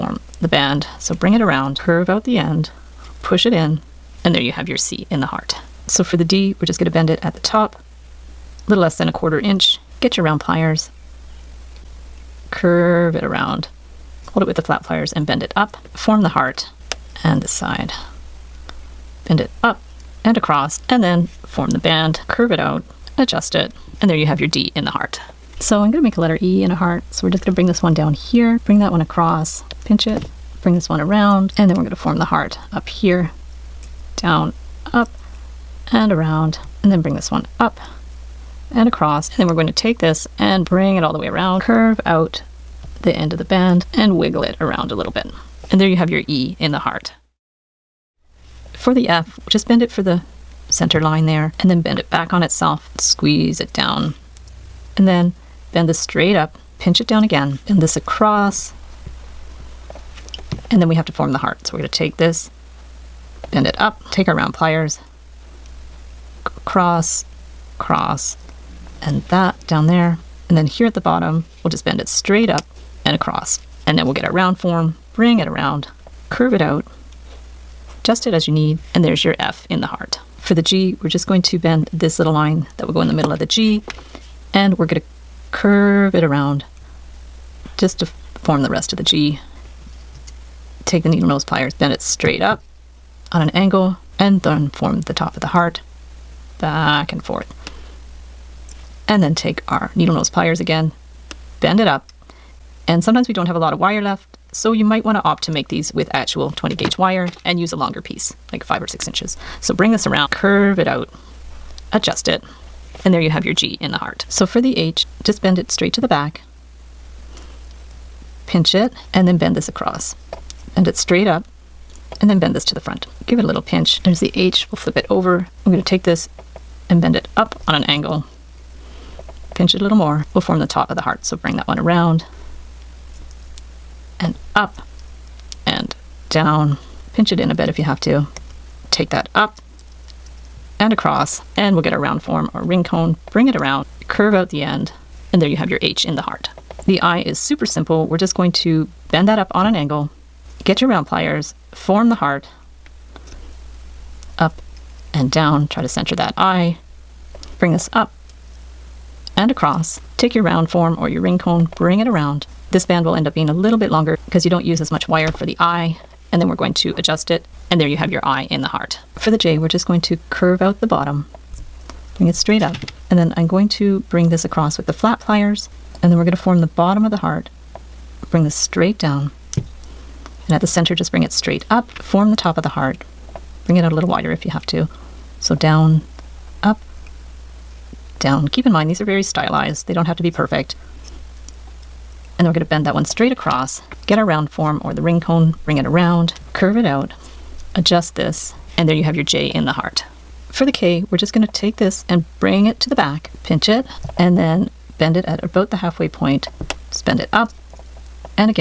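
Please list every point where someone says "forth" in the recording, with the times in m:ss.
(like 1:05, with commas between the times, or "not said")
1:37.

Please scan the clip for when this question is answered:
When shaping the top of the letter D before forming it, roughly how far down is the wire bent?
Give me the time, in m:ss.
0:08.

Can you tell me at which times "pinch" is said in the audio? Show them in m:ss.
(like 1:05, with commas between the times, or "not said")
0:29, 0:56, 1:58, 2:03, 2:09, 2:17, 3:23.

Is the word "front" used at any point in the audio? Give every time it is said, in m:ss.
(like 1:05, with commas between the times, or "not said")
2:02.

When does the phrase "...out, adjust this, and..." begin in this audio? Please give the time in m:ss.
3:16.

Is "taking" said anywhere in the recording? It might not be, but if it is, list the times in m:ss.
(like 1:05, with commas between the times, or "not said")
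not said.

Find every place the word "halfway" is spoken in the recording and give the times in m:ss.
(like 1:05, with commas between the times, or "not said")
3:25.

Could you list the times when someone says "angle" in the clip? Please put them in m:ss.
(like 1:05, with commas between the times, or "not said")
1:33, 2:07, 2:29.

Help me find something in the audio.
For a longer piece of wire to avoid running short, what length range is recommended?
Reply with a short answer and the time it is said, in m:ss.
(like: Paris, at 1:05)
5 or 6 inches, at 1:48.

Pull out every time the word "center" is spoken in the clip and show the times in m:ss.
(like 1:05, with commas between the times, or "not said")
0:50, 2:35, 3:00.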